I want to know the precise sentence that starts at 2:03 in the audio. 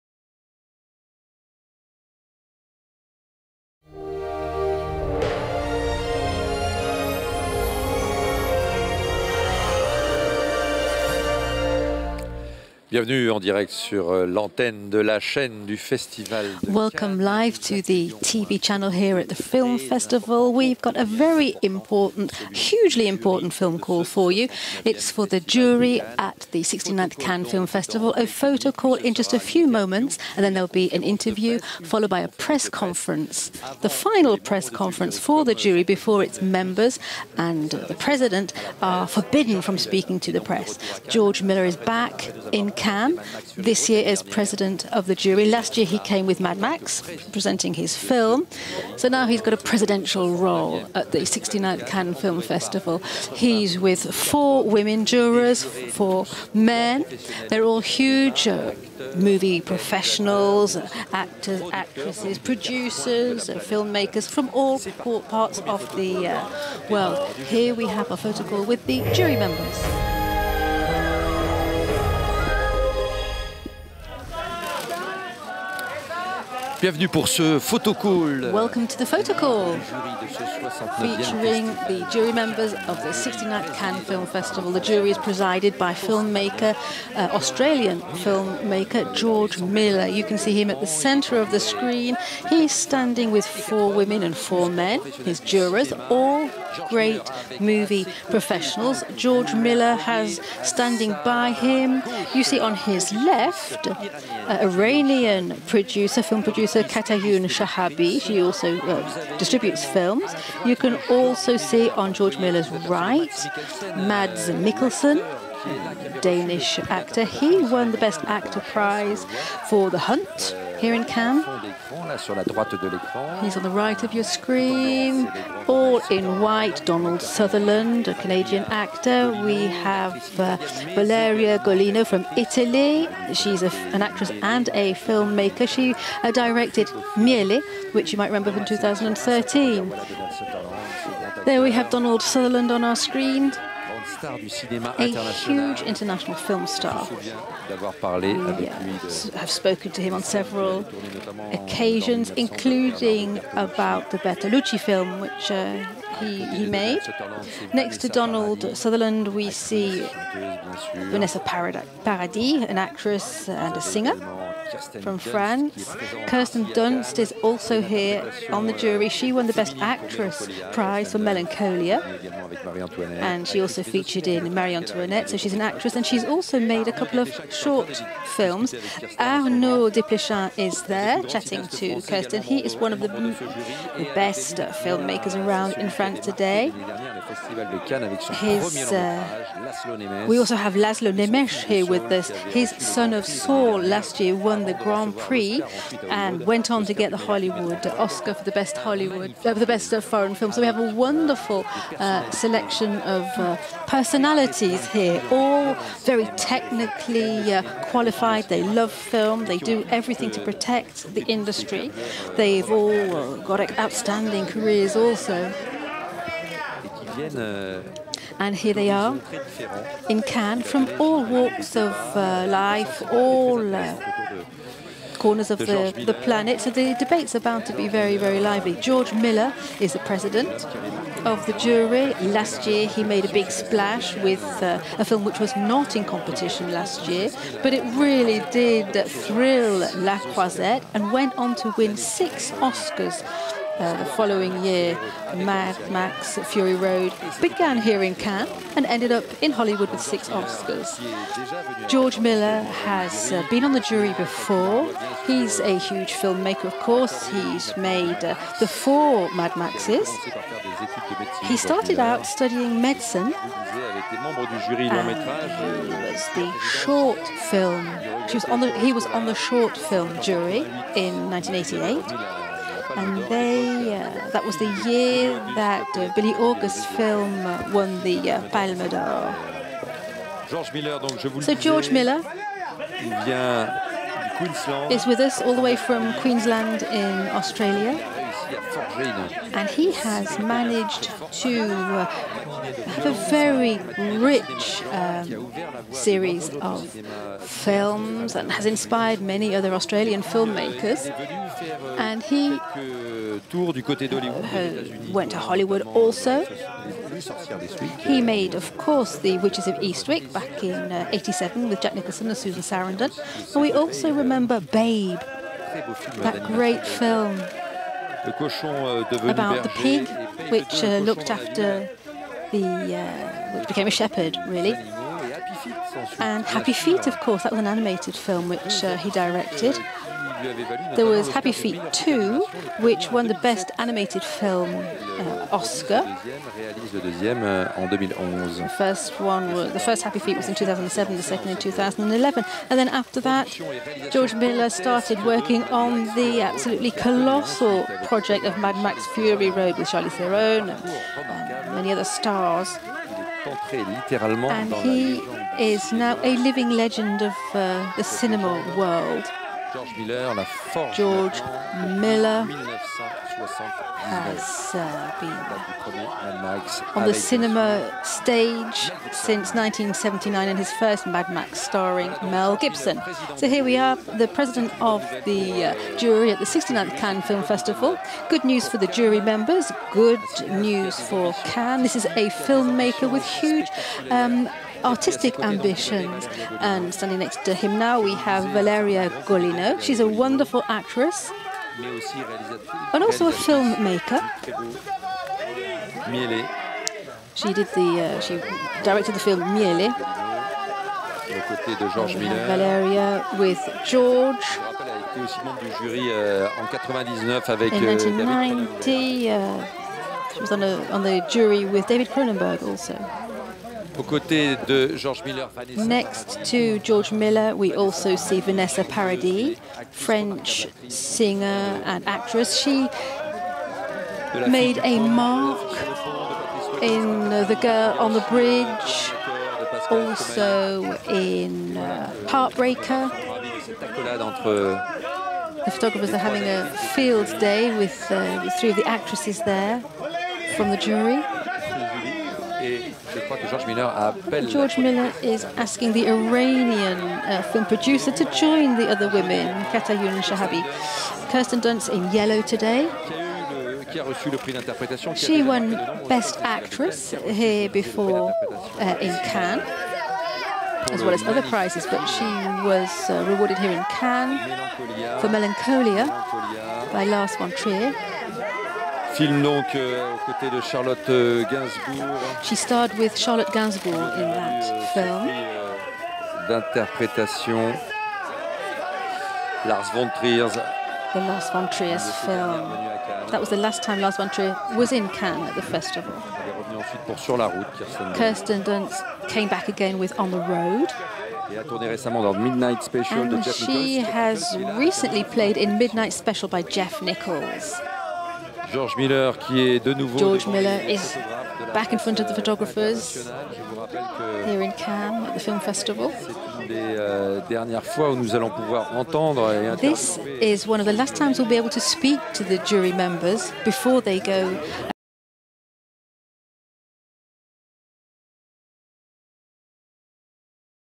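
He's on the right of your screen, all in white.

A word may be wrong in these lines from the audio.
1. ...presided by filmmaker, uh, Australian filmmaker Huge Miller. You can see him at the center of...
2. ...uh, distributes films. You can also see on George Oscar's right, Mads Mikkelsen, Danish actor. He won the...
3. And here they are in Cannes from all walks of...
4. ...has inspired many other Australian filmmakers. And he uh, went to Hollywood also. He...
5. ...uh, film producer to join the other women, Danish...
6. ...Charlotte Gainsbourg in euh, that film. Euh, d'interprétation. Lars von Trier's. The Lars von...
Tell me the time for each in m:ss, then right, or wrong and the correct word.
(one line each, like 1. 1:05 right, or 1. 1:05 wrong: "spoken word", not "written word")
1. 1:25 wrong: "George", not "Huge"
2. 1:48 wrong: "Miller", not "Oscar"
3. 3:38 right
4. 4:58 right
5. 7:27 wrong: "Katayoon", not "Danish"
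6. 7:53 right.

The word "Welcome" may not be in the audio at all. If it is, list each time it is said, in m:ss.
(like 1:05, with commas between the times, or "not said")
0:16, 1:18.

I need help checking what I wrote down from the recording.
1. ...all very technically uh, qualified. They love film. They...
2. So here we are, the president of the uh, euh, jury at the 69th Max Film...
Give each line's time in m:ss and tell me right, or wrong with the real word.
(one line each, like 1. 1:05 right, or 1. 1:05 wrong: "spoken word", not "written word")
1. 3:25 right
2. 6:13 wrong: "Cannes", not "Max".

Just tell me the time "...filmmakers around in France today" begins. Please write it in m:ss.
3:04.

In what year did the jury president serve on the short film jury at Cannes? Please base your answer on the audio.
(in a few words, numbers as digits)
1988.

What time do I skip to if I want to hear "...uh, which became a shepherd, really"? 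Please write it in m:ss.
5:22.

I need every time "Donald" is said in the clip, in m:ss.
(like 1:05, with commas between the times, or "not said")
2:06, 2:21, 2:38.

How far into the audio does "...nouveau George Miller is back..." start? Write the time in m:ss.
8:19.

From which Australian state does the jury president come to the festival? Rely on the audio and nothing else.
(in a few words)
Queensland.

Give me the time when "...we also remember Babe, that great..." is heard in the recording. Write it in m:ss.
5:13.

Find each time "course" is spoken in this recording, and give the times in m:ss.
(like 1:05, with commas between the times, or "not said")
4:16, 5:08, 5:27.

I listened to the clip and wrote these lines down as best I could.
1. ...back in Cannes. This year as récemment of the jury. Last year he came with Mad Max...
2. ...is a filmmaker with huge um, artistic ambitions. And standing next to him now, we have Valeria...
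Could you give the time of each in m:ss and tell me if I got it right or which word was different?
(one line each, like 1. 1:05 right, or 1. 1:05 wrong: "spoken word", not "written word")
1. 0:41 wrong: "president", not "récemment"
2. 6:21 right.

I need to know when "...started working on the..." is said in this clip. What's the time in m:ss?
5:44.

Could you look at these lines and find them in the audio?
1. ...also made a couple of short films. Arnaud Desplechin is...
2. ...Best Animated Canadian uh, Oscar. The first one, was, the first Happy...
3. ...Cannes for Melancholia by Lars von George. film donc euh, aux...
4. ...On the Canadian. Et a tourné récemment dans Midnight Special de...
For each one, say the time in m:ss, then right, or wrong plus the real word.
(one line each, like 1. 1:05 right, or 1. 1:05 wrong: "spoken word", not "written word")
1. 2:56 right
2. 5:33 wrong: "Film", not "Canadian"
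3. 7:43 wrong: "Trier", not "George"
4. 8:10 wrong: "Road", not "Canadian".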